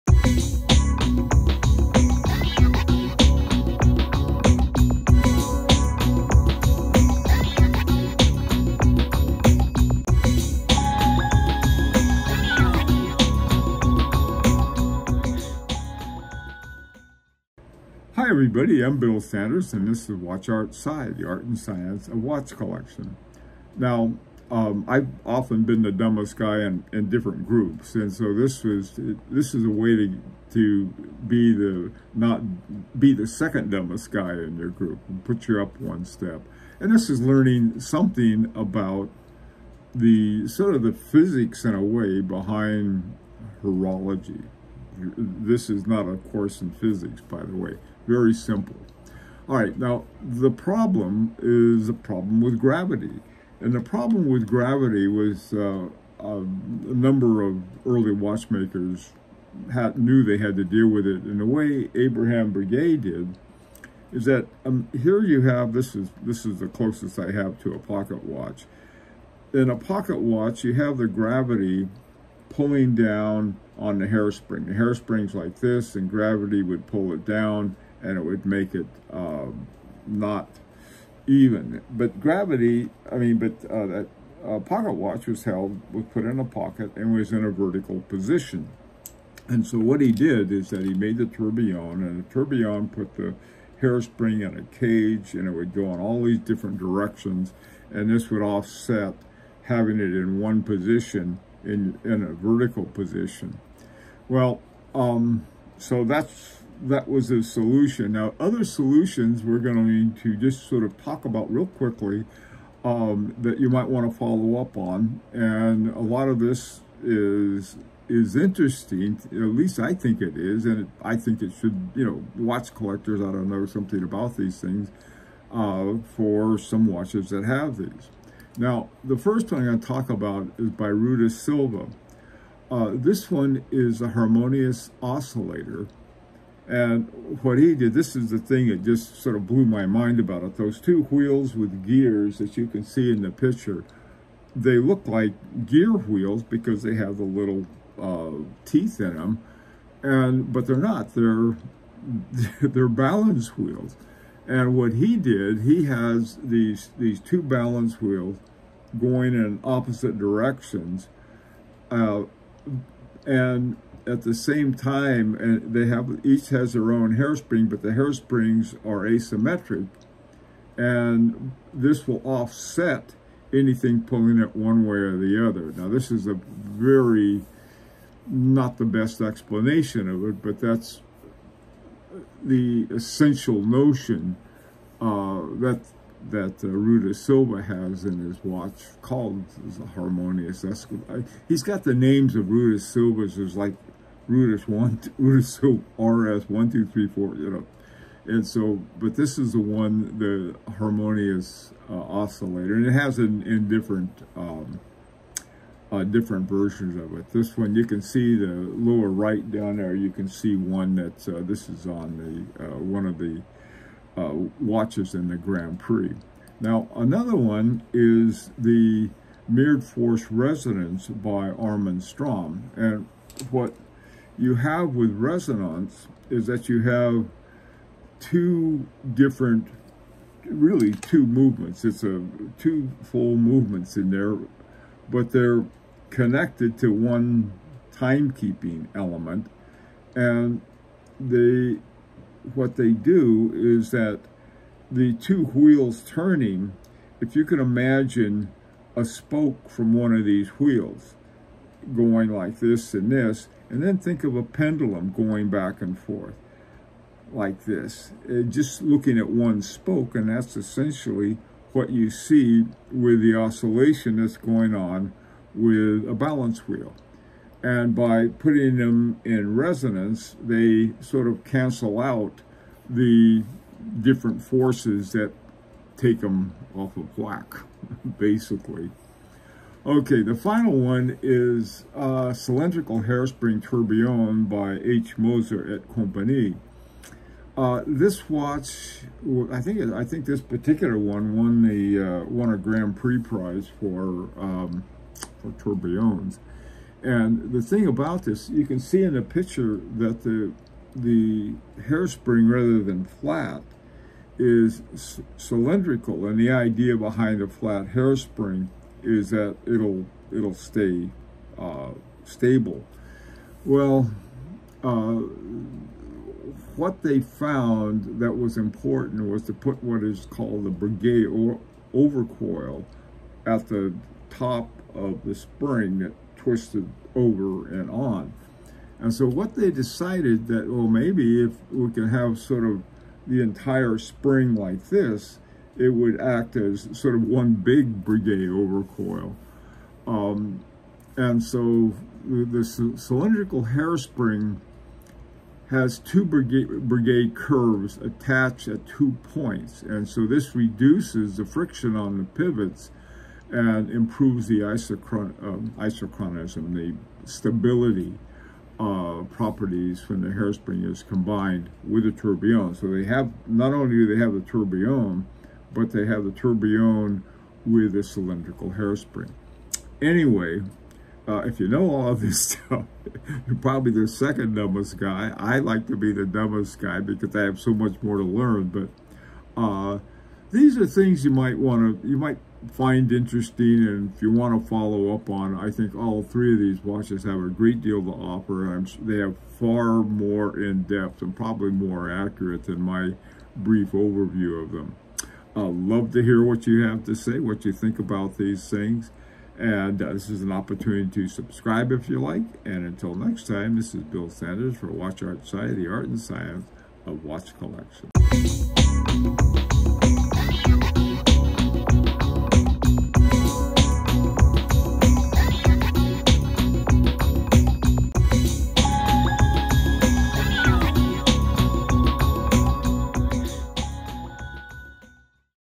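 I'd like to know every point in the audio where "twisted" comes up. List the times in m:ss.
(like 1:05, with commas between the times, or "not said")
5:26.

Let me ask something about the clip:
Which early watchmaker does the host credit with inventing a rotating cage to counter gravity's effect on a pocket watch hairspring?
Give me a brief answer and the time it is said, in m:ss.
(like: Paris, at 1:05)
Abraham Breguet, at 1:01.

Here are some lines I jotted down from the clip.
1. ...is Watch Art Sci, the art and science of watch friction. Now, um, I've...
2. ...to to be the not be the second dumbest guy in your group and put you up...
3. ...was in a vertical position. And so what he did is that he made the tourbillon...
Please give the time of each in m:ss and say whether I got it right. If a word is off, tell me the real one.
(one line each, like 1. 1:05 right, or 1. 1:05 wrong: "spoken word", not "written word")
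1. 0:20 wrong: "collection", not "friction"
2. 0:29 right
3. 1:27 right.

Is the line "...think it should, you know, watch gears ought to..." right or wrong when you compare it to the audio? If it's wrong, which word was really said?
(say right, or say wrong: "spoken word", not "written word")
wrong: "collectors", not "gears".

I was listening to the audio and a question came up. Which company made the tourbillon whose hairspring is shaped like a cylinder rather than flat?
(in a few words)
H. Moser et Compagnie.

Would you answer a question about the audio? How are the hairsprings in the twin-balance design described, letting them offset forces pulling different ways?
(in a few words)
asymmetric.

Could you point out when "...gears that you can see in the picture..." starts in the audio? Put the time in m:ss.
2:21.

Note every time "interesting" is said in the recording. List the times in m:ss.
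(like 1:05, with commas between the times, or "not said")
1:58, 6:23.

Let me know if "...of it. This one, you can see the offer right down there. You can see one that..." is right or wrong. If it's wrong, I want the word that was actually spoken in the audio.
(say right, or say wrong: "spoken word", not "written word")
wrong: "lower", not "offer".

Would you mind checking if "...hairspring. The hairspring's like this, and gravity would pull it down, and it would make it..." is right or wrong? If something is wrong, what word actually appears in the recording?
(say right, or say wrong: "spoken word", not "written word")
right.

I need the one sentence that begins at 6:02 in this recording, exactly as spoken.
So they have, not only do they have the tourbillon, but they have the tourbillon with a cylindrical hairspring.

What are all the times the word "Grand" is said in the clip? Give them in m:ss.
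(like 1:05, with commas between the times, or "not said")
3:35, 4:52.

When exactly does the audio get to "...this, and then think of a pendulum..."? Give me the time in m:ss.
4:13.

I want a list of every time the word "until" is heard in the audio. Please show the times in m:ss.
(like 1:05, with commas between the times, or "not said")
6:42.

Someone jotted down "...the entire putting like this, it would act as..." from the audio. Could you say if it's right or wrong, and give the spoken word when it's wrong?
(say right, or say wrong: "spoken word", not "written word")
wrong: "spring", not "putting".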